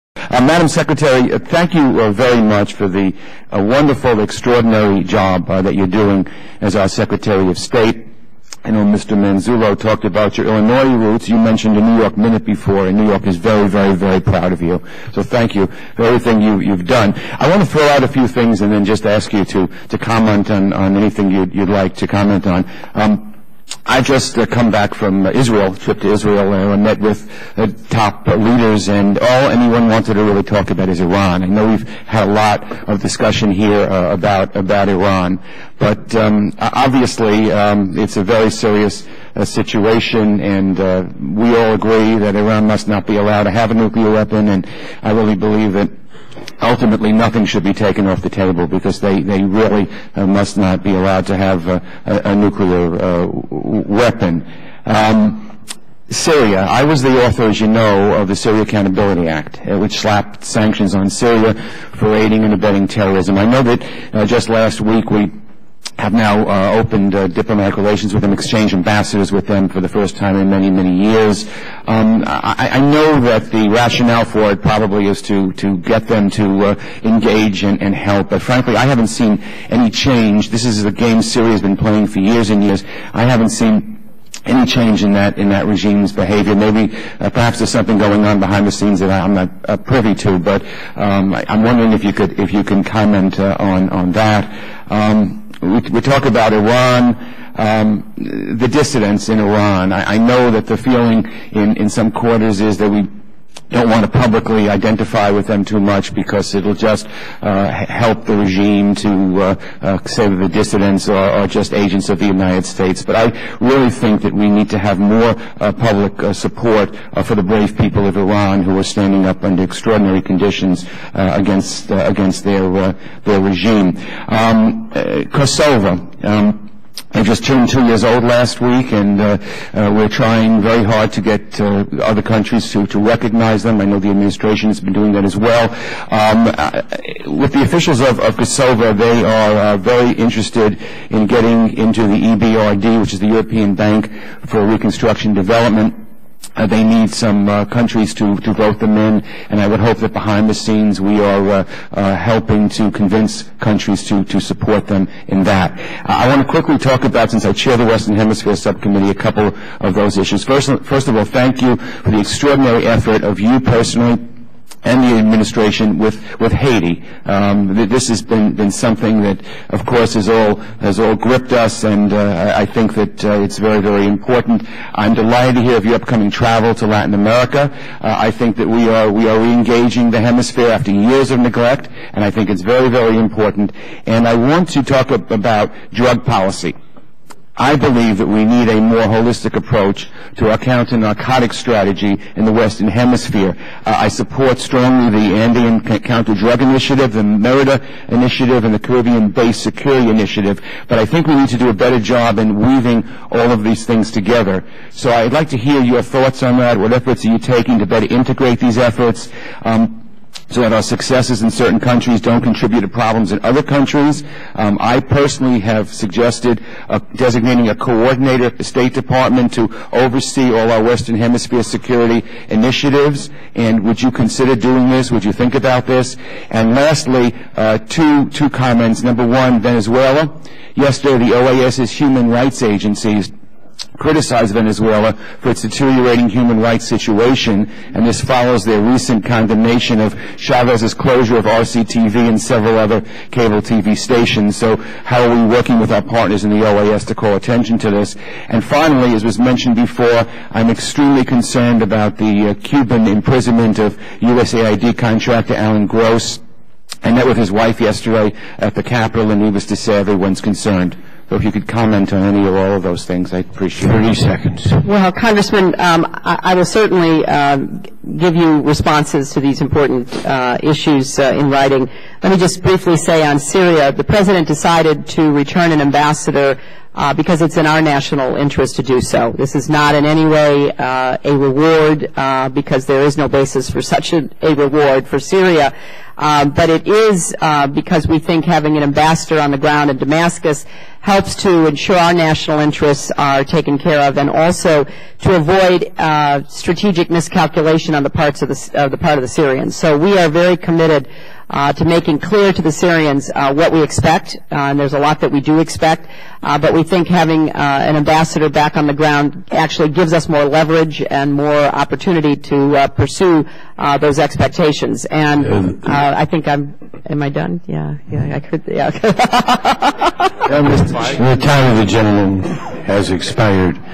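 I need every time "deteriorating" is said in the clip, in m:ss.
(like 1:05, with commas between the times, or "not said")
3:55.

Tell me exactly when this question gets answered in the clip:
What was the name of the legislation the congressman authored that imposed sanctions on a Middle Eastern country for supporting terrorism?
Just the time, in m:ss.
0:58.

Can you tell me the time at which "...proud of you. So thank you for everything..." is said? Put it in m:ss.
0:14.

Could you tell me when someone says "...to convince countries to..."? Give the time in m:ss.
2:32.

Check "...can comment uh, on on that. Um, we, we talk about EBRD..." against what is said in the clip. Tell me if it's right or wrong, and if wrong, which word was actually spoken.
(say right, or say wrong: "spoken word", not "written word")
wrong: "Iran", not "EBRD".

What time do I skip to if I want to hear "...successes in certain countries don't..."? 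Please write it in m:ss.
3:30.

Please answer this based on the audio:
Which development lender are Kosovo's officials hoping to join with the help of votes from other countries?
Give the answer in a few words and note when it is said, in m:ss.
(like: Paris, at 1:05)
European Bank for Reconstruction Development, at 2:23.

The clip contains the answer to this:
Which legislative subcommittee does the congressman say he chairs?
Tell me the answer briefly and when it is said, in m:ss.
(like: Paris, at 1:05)
Western Hemisphere Subcommittee, at 2:37.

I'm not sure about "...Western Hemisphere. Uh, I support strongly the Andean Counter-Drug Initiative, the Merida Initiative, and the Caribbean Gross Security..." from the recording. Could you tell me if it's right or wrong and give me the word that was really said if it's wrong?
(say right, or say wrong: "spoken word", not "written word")
wrong: "Basin", not "Gross".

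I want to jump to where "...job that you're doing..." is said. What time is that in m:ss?
0:05.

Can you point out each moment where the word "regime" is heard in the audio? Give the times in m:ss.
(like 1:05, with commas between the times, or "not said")
1:25, 1:48, 2:03.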